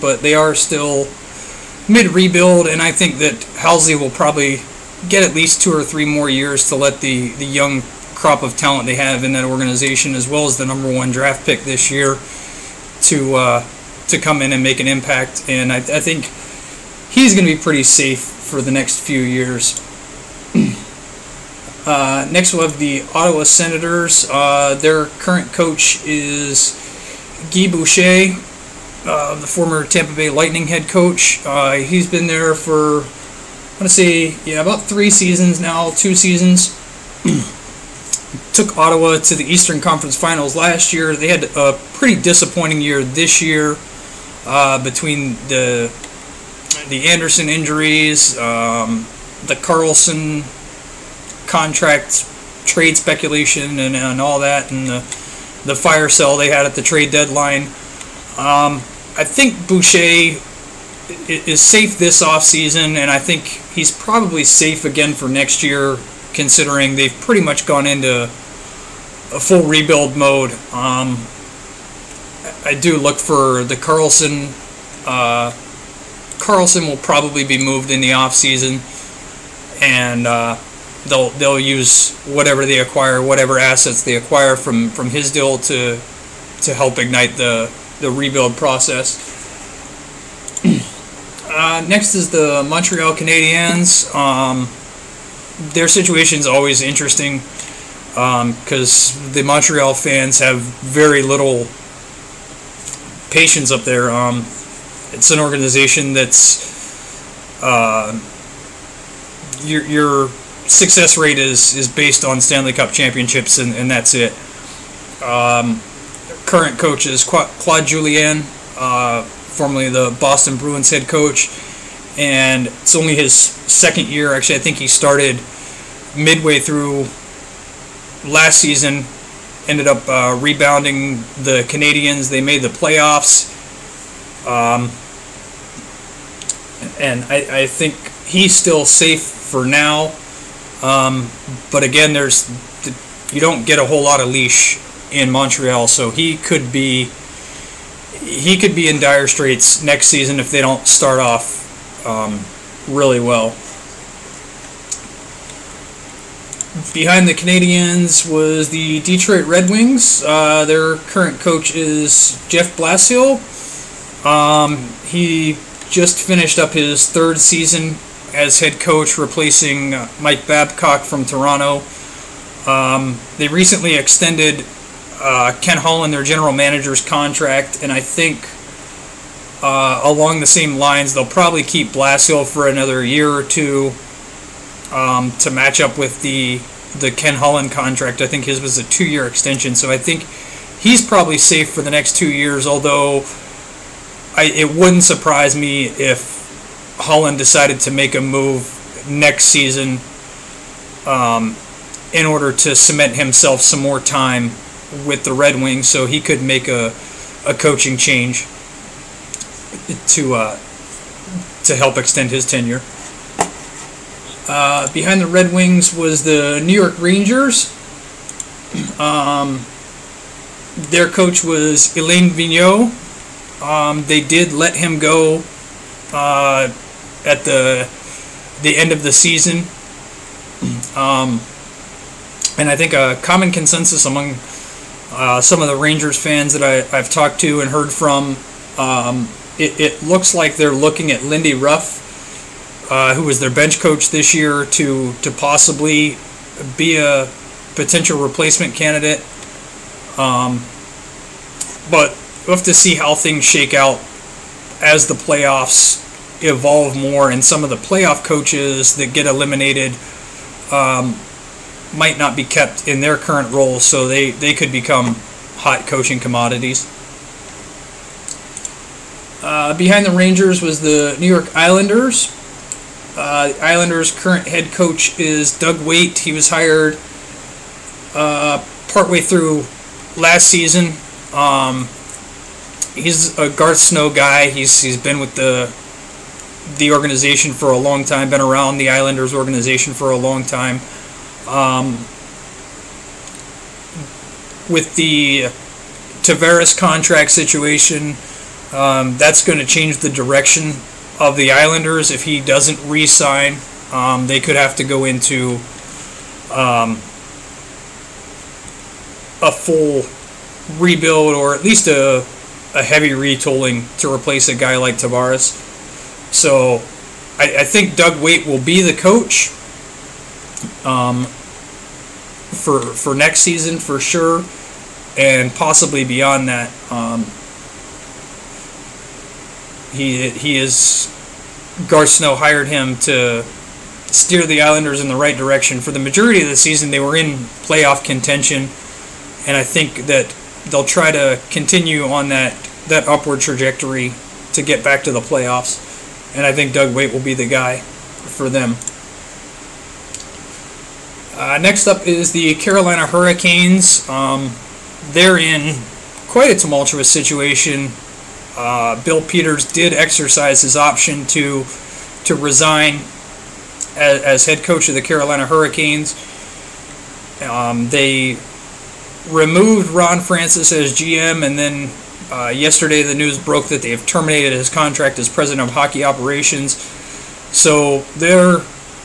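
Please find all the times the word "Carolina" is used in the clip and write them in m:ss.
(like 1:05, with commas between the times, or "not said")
5:52, 6:04.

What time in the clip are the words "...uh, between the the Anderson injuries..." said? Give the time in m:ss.
0:44.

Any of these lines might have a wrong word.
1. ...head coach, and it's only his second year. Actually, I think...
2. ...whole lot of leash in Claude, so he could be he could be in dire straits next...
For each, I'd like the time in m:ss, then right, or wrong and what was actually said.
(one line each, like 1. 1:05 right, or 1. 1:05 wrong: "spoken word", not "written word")
1. 2:00 right
2. 2:23 wrong: "Montreal", not "Claude".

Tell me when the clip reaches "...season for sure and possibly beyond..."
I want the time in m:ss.
5:23.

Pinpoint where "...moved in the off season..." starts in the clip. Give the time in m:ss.
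1:17.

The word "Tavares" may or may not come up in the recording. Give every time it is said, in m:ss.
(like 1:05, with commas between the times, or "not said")
4:56, 5:14.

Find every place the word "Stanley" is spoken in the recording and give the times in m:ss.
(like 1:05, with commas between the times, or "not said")
1:52.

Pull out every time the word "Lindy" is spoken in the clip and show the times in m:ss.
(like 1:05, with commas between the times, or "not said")
4:01.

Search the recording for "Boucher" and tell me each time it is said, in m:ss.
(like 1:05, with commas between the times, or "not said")
0:27, 0:59.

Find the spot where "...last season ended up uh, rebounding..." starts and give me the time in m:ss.
2:08.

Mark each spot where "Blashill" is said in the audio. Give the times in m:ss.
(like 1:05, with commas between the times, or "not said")
2:42, 3:01.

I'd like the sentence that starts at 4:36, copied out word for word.
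He was hired uh, partway through last season.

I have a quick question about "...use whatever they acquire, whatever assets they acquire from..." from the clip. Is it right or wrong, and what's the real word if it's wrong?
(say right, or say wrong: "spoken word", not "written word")
right.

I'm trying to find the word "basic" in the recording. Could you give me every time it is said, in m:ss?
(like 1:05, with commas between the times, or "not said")
not said.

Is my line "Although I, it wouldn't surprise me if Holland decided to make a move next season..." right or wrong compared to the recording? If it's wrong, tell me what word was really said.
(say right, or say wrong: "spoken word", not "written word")
right.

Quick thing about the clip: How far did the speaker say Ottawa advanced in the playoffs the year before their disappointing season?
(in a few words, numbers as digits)
Eastern Conference Finals.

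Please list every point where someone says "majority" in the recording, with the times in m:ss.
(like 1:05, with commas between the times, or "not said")
5:35.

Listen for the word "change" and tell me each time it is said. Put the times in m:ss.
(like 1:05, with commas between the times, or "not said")
3:27, 4:59.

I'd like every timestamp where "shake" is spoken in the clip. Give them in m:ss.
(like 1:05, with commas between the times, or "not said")
4:13.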